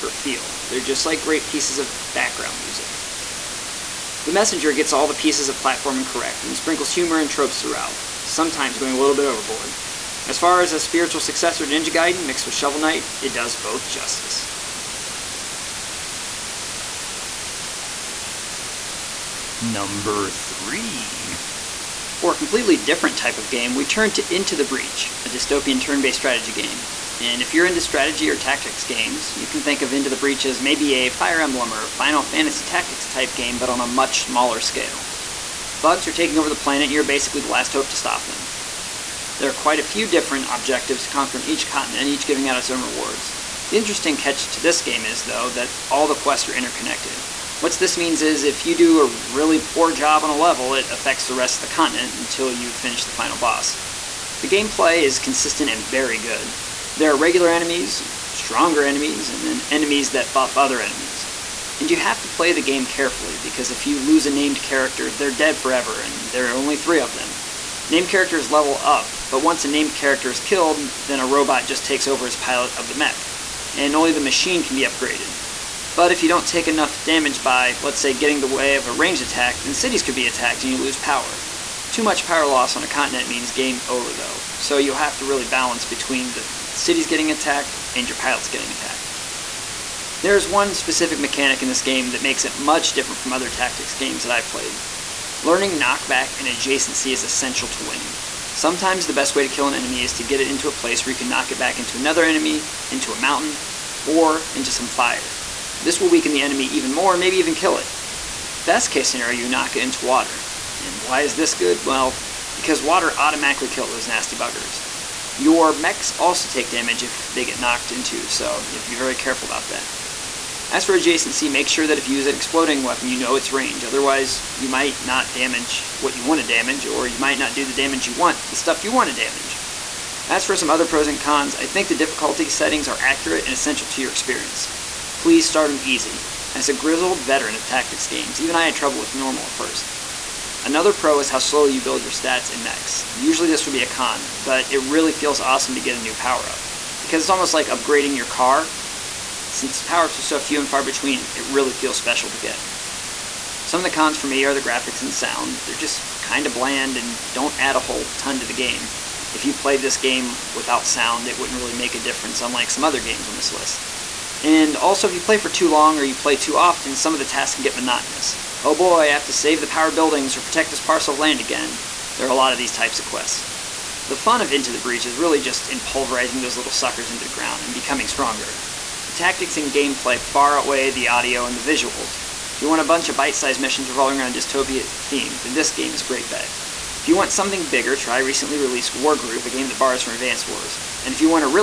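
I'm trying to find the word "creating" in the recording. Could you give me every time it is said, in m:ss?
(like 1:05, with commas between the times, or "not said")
not said.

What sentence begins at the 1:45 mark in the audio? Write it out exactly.
This will weaken the enemy even more and maybe even kill it.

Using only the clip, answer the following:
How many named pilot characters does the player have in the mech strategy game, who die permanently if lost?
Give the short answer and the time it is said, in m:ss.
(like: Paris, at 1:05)
3, at 1:06.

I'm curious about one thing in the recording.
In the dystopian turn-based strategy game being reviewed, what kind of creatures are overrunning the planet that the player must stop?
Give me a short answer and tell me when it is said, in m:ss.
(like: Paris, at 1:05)
Bugs, at 0:35.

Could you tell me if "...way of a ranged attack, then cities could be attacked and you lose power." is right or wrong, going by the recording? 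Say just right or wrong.
right.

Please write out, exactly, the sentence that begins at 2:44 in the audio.
And also, if you play for too long or you play too often, some of the tasks can get monotonous.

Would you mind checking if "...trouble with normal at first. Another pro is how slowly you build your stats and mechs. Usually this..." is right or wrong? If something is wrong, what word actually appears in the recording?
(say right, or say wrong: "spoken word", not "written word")
right.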